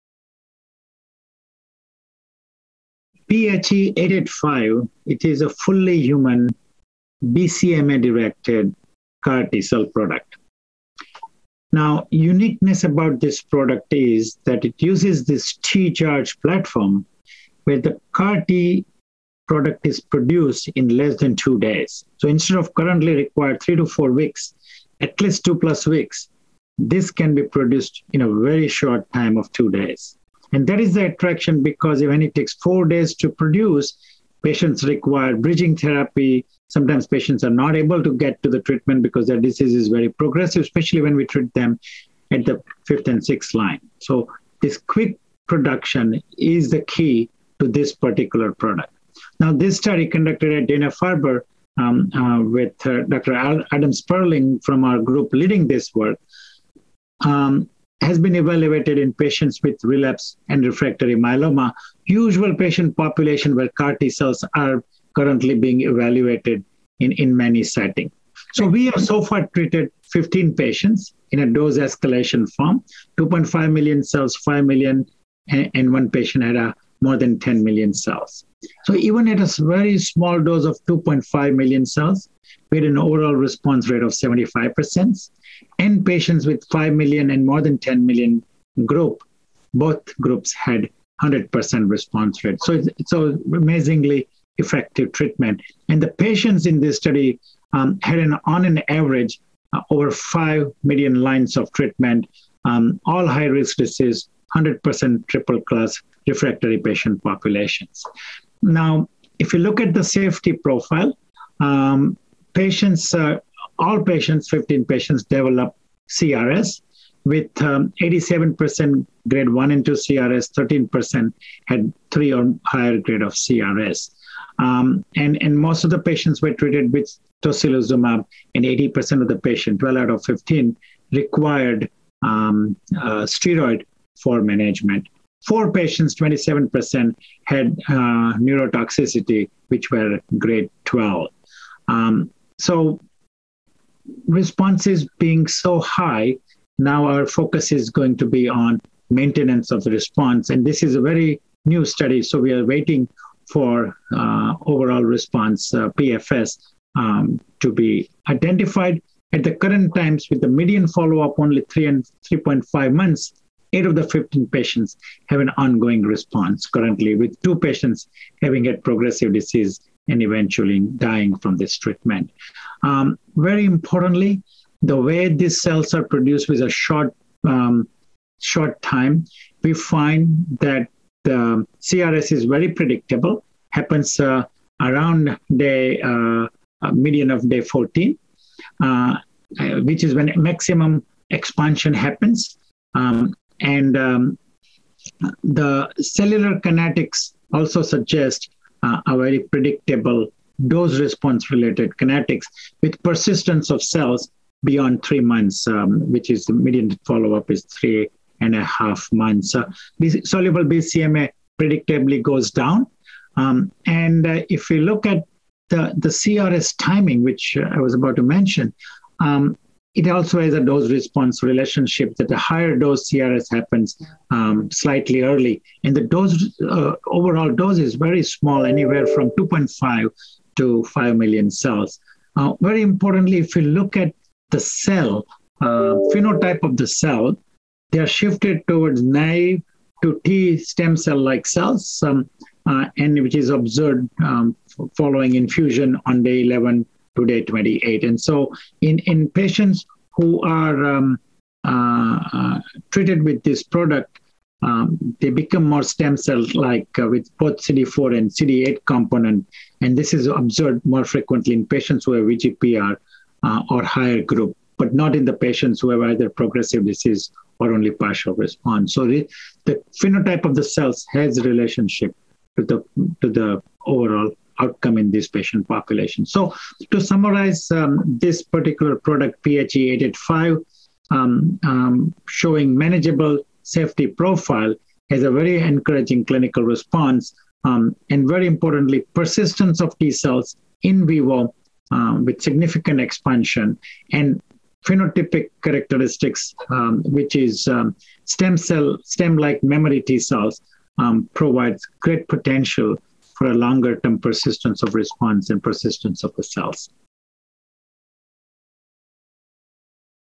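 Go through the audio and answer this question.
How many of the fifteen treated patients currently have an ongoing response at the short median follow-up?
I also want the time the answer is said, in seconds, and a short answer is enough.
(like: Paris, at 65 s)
8, at 163 s.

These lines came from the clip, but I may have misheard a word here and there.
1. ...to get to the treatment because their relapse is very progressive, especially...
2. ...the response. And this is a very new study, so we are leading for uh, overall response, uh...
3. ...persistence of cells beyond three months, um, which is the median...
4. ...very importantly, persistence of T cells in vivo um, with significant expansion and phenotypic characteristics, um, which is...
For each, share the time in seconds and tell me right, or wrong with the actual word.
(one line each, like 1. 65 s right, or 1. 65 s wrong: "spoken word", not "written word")
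1. 38 s wrong: "disease", not "relapse"
2. 149 s wrong: "waiting", not "leading"
3. 203 s right
4. 288 s right.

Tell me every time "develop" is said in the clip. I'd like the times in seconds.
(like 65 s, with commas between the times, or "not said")
115 s.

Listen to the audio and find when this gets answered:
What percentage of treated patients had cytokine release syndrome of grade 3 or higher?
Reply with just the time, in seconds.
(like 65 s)
120 s.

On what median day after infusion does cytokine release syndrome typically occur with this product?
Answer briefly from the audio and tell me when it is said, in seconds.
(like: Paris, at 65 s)
Day 14, at 187 s.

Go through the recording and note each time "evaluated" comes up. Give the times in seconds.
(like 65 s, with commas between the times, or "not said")
58 s, 65 s.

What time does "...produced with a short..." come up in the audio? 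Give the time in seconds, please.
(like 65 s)
176 s.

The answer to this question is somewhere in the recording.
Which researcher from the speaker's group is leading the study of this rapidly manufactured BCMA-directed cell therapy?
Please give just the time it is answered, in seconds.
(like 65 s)
53 s.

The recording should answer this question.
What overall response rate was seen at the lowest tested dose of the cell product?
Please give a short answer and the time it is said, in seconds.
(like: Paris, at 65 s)
75%, at 84 s.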